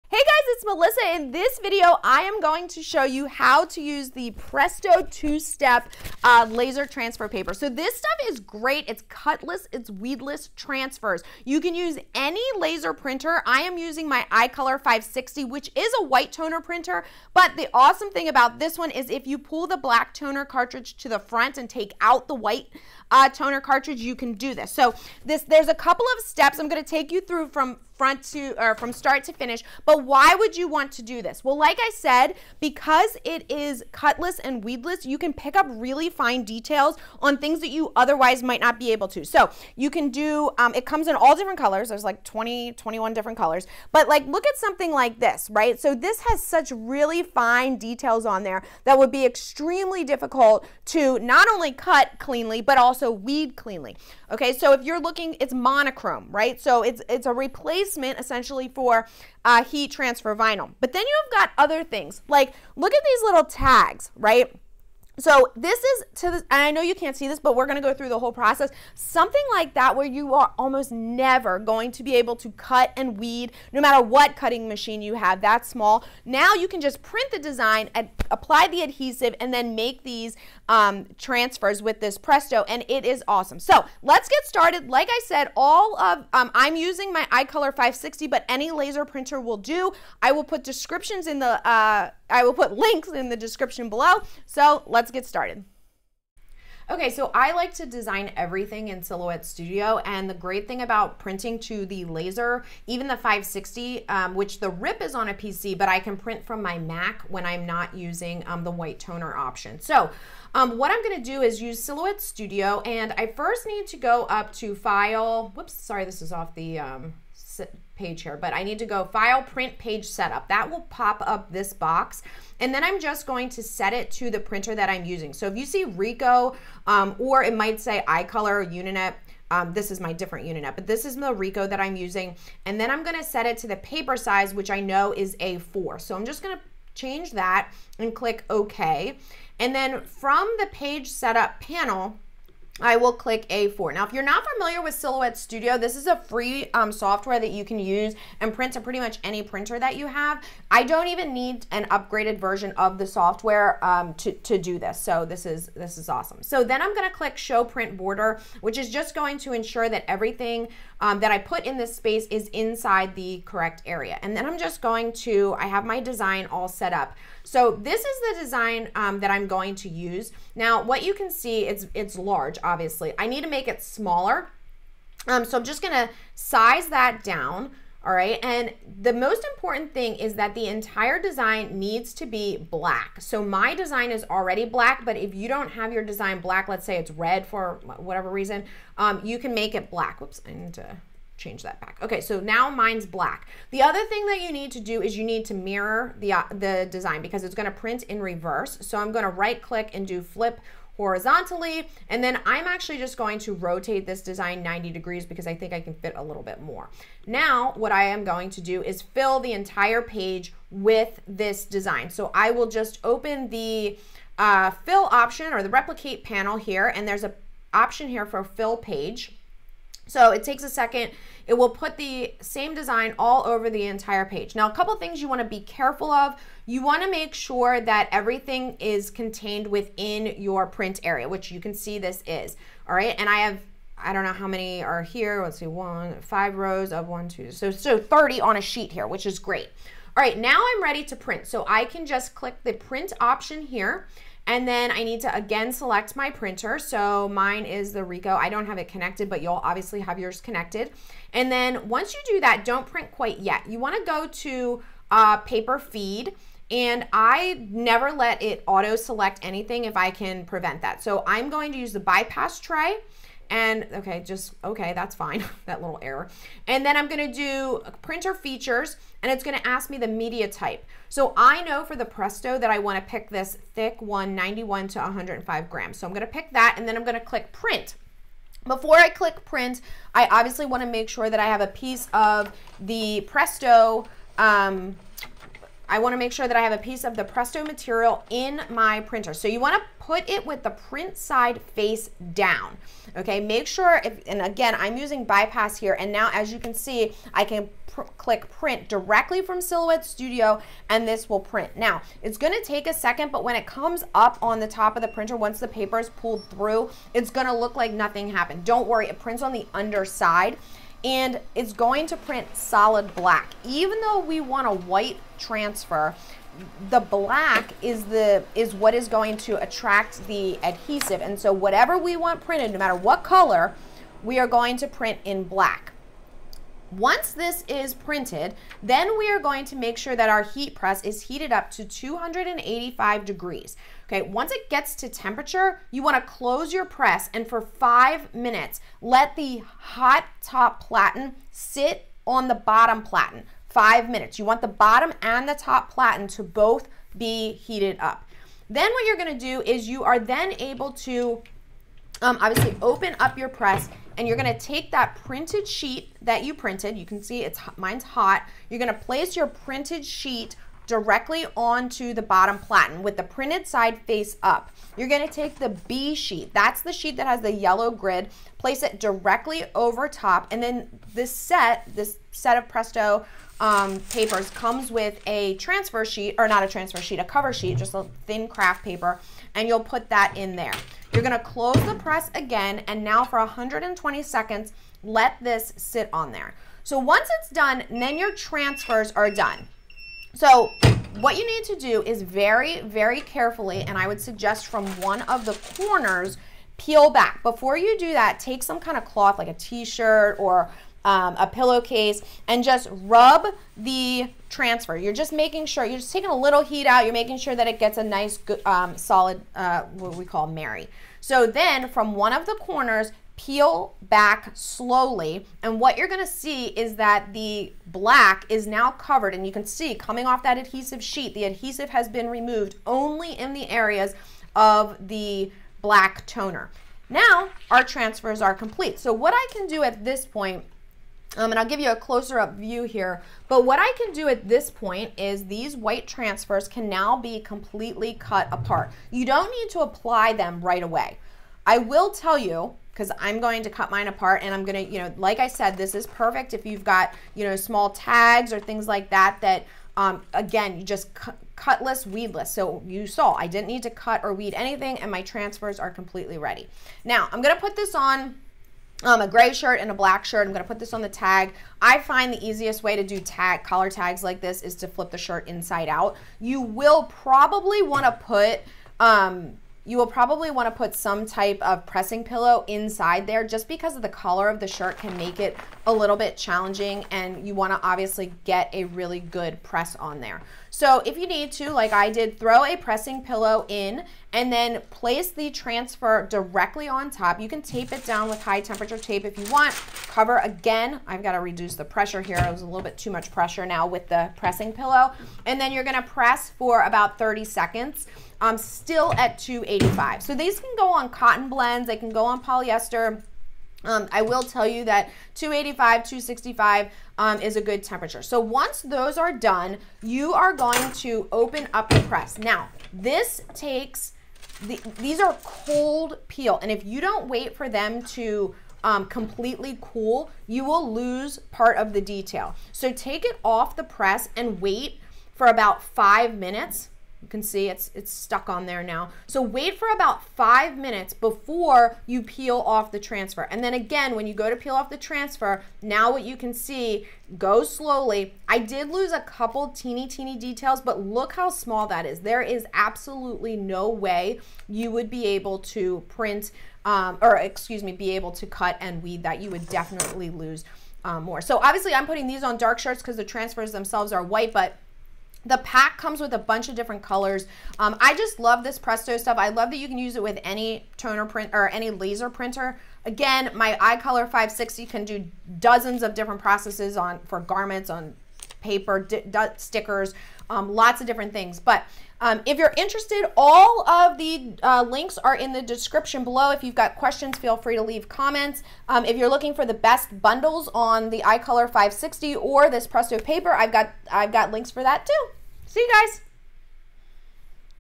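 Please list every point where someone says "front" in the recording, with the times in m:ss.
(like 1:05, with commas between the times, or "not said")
0:21, 0:28.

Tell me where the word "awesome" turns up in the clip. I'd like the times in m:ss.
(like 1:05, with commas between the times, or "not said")
0:17, 1:23, 2:36.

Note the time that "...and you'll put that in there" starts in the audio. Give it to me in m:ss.
6:19.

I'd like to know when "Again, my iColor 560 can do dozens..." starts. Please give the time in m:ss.
9:23.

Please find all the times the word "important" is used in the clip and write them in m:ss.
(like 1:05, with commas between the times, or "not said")
2:59.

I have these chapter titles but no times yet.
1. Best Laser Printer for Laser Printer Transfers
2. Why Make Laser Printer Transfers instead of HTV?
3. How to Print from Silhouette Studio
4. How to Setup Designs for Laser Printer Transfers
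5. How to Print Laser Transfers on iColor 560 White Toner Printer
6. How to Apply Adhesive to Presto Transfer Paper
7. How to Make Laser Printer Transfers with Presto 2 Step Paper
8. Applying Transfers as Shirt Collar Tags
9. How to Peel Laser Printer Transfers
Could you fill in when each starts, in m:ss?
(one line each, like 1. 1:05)
1. 0:21
2. 0:33
3. 4:08
4. 1:39
5. 4:56
6. 5:35
7. 6:40
8. 7:42
9. 8:37.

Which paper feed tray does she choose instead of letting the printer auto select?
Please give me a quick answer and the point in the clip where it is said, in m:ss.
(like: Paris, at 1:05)
bypass tray, at 4:21.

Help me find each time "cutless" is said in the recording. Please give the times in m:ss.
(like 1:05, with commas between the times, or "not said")
0:09, 0:33, 7:31.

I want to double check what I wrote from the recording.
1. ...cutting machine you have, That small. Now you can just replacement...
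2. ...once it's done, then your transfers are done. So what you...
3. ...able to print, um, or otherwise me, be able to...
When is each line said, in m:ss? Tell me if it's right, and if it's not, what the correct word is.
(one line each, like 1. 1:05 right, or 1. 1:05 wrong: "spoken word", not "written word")
1. 1:14 wrong: "print", not "replacement"
2. 6:26 right
3. 9:05 wrong: "excuse", not "otherwise".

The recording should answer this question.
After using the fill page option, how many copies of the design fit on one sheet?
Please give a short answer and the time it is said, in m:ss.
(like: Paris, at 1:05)
30, at 3:57.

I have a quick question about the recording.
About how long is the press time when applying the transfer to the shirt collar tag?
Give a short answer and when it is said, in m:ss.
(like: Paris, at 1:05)
30 seconds, at 8:17.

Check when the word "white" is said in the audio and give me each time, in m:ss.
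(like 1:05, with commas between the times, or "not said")
0:16, 0:22, 1:48, 5:14, 7:15, 9:14.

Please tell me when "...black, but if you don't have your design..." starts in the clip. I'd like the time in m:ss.
3:04.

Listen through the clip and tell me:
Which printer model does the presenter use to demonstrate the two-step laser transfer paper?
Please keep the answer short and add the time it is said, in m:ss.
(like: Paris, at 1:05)
iColor 560, at 0:14.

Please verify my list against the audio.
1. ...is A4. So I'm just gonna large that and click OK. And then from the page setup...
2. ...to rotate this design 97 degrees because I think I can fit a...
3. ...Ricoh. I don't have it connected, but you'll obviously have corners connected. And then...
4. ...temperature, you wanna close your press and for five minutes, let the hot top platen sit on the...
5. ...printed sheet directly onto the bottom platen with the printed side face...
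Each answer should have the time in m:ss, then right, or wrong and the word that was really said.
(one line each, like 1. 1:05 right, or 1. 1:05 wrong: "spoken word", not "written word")
1. 2:15 wrong: "change", not "large"
2. 3:23 wrong: "90", not "97"
3. 4:08 wrong: "yours", not "corners"
4. 5:35 right
5. 5:59 right.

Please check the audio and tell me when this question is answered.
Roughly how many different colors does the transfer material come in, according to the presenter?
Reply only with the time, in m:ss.
0:42.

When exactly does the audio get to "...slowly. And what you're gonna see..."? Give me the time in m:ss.
6:54.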